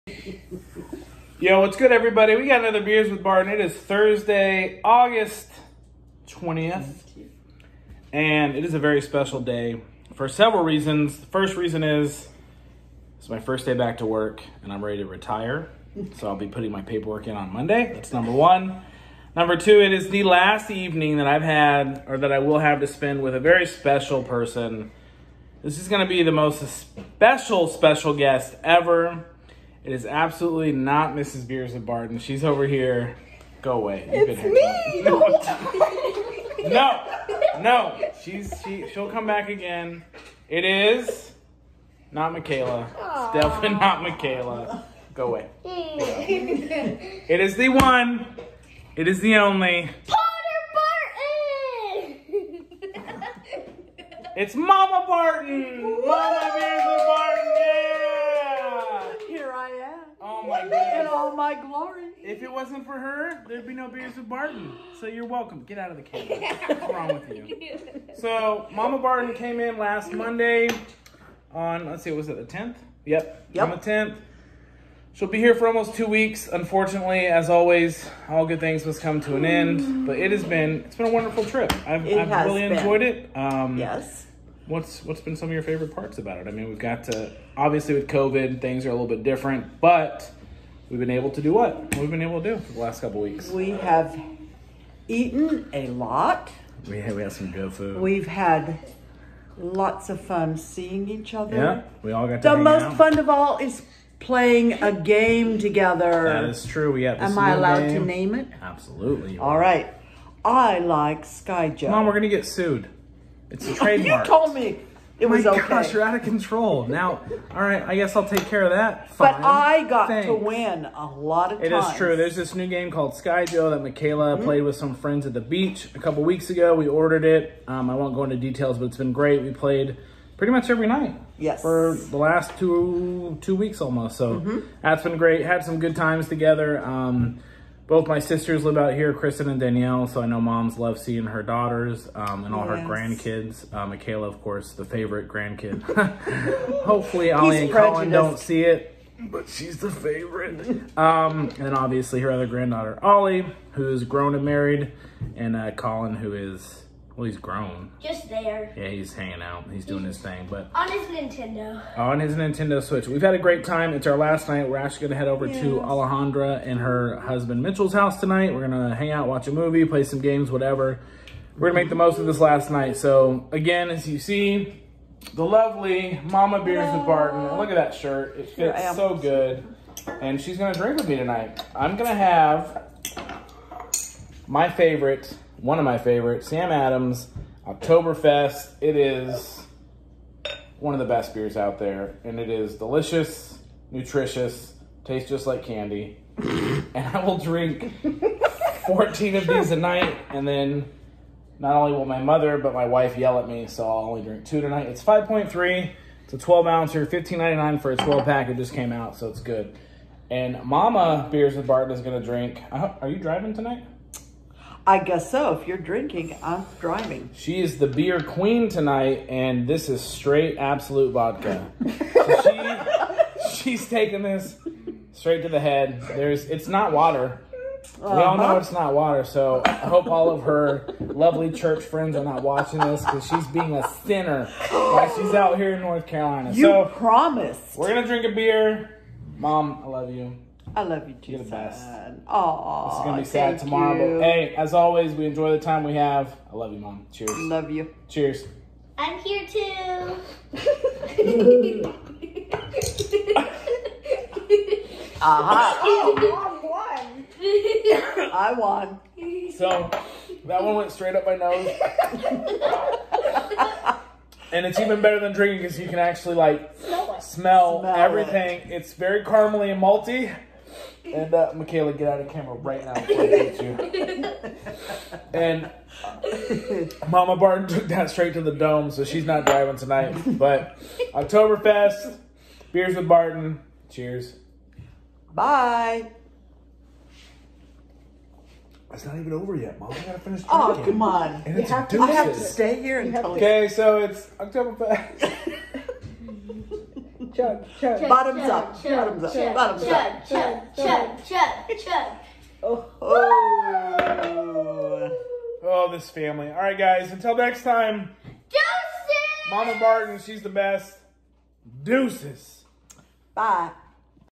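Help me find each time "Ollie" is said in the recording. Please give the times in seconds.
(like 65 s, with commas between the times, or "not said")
147 s, 153 s.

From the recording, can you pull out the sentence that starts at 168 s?
We're gonna hang out, watch a movie, play some games, whatever.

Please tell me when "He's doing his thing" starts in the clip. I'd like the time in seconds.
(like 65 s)
159 s.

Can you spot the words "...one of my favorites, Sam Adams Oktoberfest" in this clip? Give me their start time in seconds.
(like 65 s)
185 s.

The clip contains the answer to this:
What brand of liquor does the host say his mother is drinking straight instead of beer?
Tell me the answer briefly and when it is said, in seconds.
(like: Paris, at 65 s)
Absolut, at 220 s.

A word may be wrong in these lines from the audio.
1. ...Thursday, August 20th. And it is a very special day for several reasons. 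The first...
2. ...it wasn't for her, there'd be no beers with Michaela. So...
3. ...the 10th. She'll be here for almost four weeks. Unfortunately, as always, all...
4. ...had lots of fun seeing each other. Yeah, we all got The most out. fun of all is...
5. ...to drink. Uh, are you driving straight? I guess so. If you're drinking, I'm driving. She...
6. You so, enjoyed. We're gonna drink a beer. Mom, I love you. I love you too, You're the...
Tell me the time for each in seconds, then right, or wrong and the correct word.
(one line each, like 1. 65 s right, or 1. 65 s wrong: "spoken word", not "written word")
1. 3 s right
2. 62 s wrong: "Barton", not "Michaela"
3. 73 s wrong: "two", not "four"
4. 98 s right
5. 212 s wrong: "tonight", not "straight"
6. 236 s wrong: "promised", not "enjoyed".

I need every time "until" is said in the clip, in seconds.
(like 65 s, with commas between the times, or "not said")
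292 s, 307 s.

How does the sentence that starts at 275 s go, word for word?
and uh, Mama Barton took that straight to the dome, so she's not driving tonight.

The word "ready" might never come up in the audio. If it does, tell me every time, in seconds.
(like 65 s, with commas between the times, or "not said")
14 s.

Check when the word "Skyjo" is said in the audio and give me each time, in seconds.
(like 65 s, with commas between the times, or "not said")
111 s, 123 s.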